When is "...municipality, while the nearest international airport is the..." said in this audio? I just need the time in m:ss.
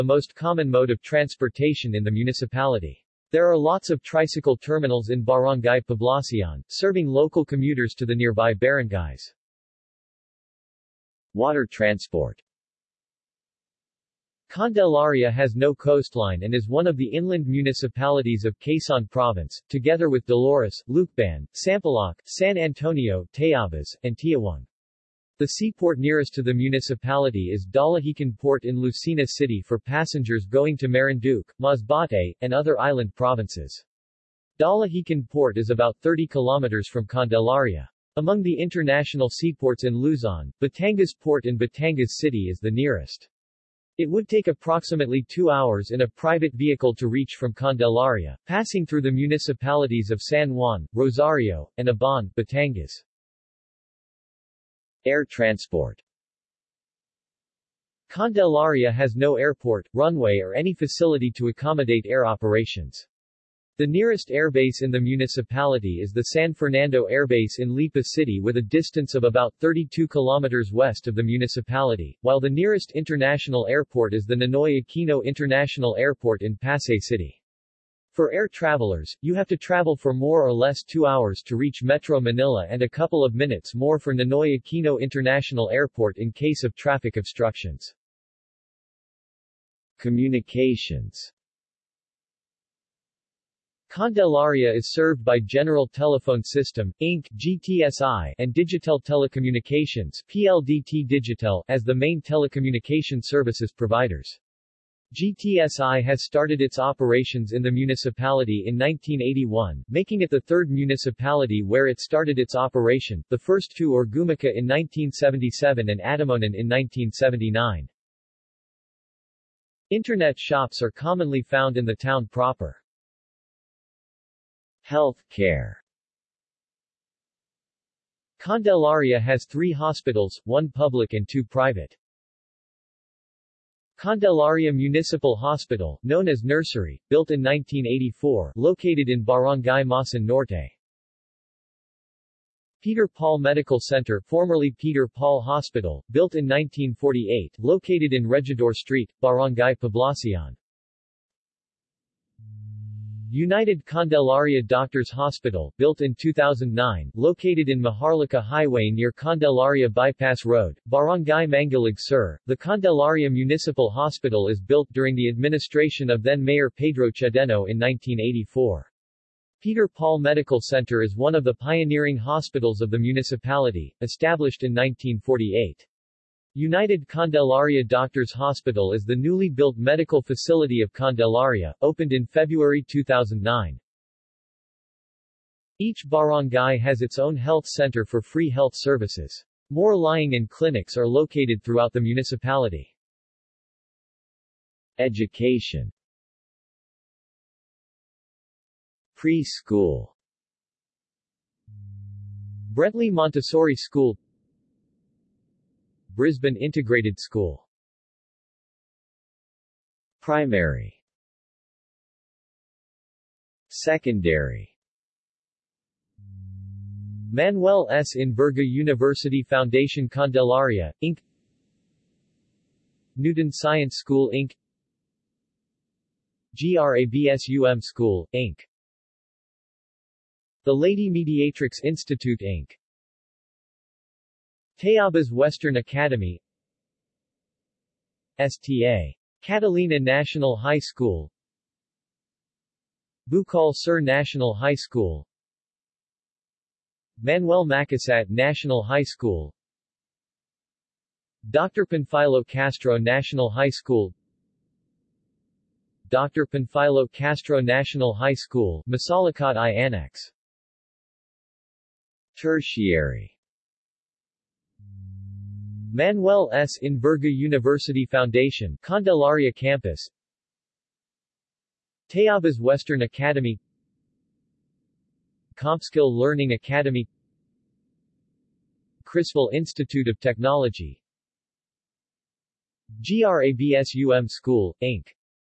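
1:11.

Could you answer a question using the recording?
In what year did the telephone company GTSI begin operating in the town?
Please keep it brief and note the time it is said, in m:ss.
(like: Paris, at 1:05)
1981, at 1:48.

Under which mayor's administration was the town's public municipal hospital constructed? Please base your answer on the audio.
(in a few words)
Pedro Chedeno.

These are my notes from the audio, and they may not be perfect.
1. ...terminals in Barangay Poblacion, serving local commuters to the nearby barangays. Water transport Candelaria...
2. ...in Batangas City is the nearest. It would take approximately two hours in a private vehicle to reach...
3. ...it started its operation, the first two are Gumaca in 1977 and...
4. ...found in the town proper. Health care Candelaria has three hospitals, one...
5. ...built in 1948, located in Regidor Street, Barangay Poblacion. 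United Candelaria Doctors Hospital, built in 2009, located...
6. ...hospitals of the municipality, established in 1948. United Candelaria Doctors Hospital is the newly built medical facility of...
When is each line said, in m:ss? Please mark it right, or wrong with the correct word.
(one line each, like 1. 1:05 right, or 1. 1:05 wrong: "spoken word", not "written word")
1. 0:04 right
2. 0:41 right
3. 1:51 right
4. 2:01 right
5. 2:26 right
6. 2:52 right.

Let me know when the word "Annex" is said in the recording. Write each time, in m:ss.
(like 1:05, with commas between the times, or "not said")
4:19.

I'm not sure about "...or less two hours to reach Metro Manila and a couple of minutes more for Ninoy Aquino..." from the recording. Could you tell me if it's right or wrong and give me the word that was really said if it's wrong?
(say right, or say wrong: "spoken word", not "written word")
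right.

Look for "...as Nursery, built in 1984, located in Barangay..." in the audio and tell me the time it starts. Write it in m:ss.
2:16.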